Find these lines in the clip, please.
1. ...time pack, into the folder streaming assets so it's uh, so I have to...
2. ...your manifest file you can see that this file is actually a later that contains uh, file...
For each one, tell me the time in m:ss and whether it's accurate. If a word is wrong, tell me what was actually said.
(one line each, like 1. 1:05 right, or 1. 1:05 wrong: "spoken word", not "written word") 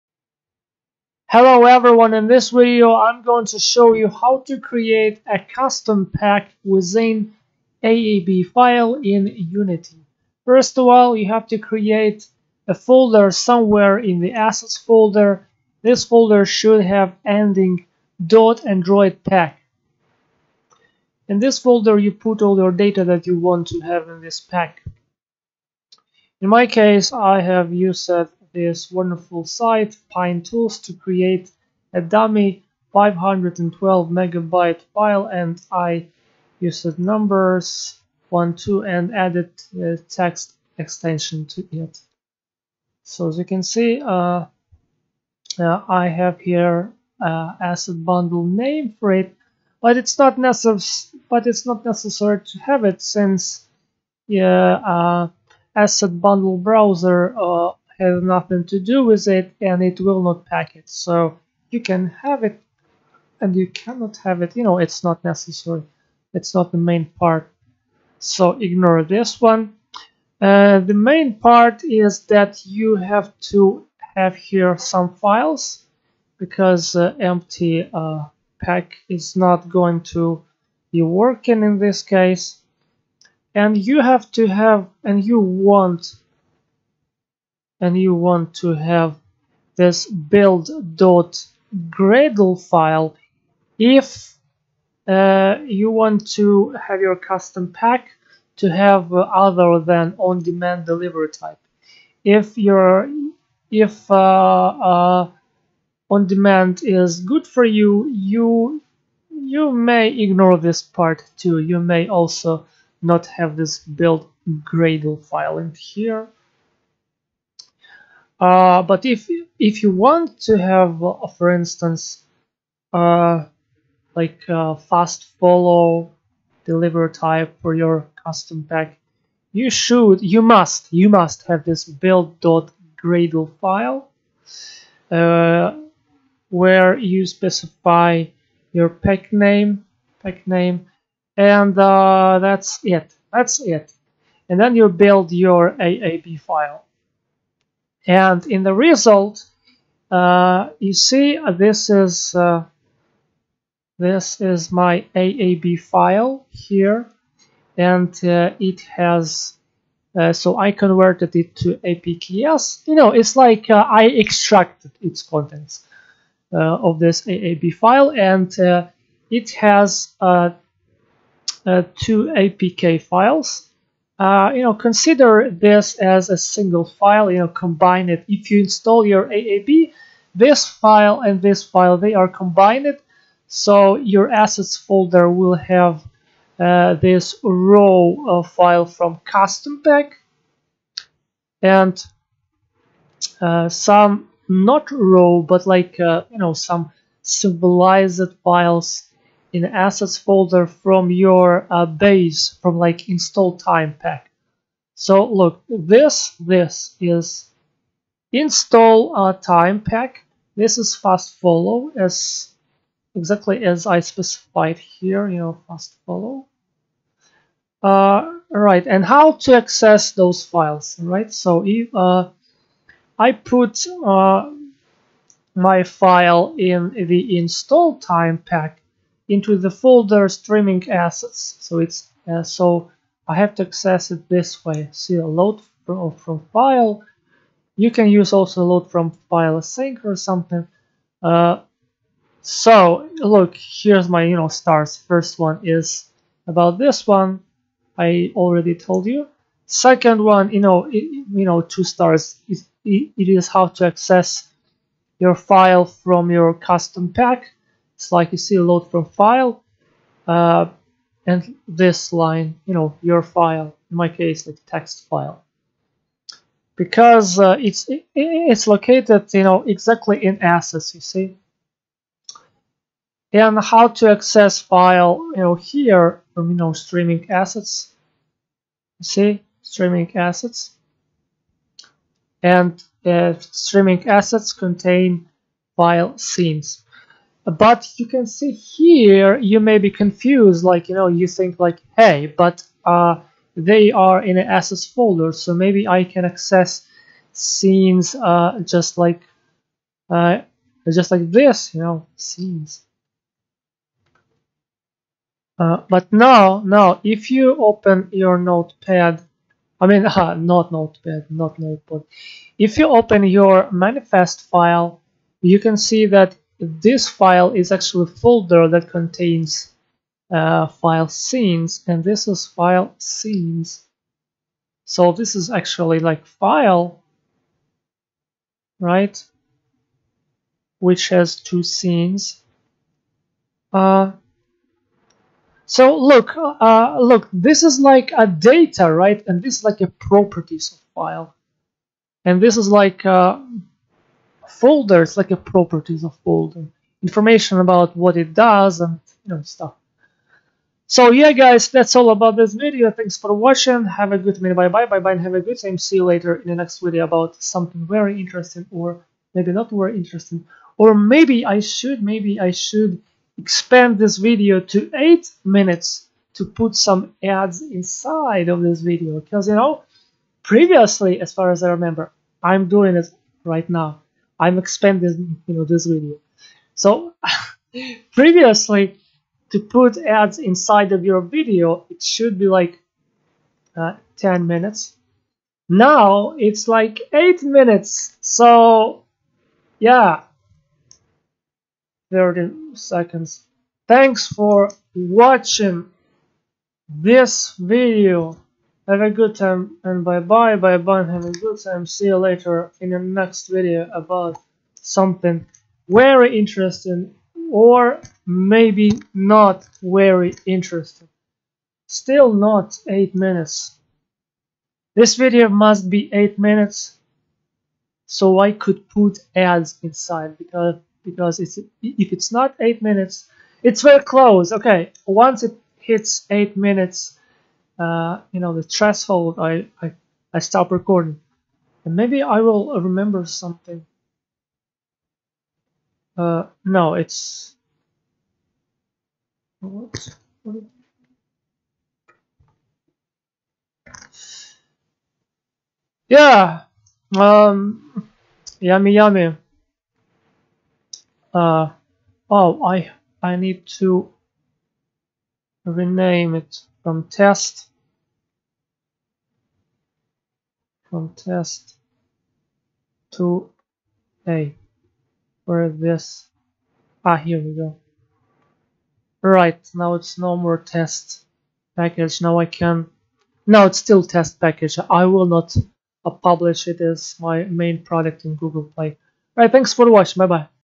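1. 3:47 right
2. 5:13 wrong: "folder", not "later".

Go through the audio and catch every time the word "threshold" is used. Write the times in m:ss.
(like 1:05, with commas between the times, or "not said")
7:08.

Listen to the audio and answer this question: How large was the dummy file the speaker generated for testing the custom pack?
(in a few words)
512 megabytes.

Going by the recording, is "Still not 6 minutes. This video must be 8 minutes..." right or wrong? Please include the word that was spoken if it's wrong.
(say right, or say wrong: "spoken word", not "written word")
wrong: "8", not "6".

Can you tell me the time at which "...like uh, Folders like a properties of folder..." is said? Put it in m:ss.
5:42.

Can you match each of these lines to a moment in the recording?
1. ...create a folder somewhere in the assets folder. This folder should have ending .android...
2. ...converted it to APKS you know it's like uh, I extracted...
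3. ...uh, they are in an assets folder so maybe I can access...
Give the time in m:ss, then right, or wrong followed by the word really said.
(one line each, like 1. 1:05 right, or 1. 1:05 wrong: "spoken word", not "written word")
1. 0:11 right
2. 2:40 right
3. 4:52 right.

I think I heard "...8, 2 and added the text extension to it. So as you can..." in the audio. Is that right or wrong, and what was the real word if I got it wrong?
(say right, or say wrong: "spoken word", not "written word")
wrong: "1", not "8".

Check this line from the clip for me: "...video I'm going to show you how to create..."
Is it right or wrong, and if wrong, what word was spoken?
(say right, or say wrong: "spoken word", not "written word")
right.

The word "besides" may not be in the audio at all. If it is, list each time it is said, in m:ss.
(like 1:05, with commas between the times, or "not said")
not said.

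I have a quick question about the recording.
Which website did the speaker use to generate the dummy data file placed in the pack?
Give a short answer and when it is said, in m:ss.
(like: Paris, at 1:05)
Pine Tools, at 0:30.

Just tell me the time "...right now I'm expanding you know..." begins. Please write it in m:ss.
6:13.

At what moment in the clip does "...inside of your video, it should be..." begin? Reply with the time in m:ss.
6:20.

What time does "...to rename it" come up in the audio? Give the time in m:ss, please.
7:33.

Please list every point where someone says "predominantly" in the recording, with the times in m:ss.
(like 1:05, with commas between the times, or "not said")
not said.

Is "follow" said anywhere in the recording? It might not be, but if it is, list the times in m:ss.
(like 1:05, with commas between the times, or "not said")
2:05, 3:31, 3:36.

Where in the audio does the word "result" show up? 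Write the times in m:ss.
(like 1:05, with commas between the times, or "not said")
2:28.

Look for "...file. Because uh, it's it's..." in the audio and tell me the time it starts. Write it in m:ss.
4:25.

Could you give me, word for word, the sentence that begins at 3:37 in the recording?
Uh, right, and how to access those files, right?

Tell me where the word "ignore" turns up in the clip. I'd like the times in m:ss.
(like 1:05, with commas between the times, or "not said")
1:08, 1:50.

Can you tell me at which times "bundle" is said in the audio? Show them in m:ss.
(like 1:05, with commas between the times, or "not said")
0:48, 0:56.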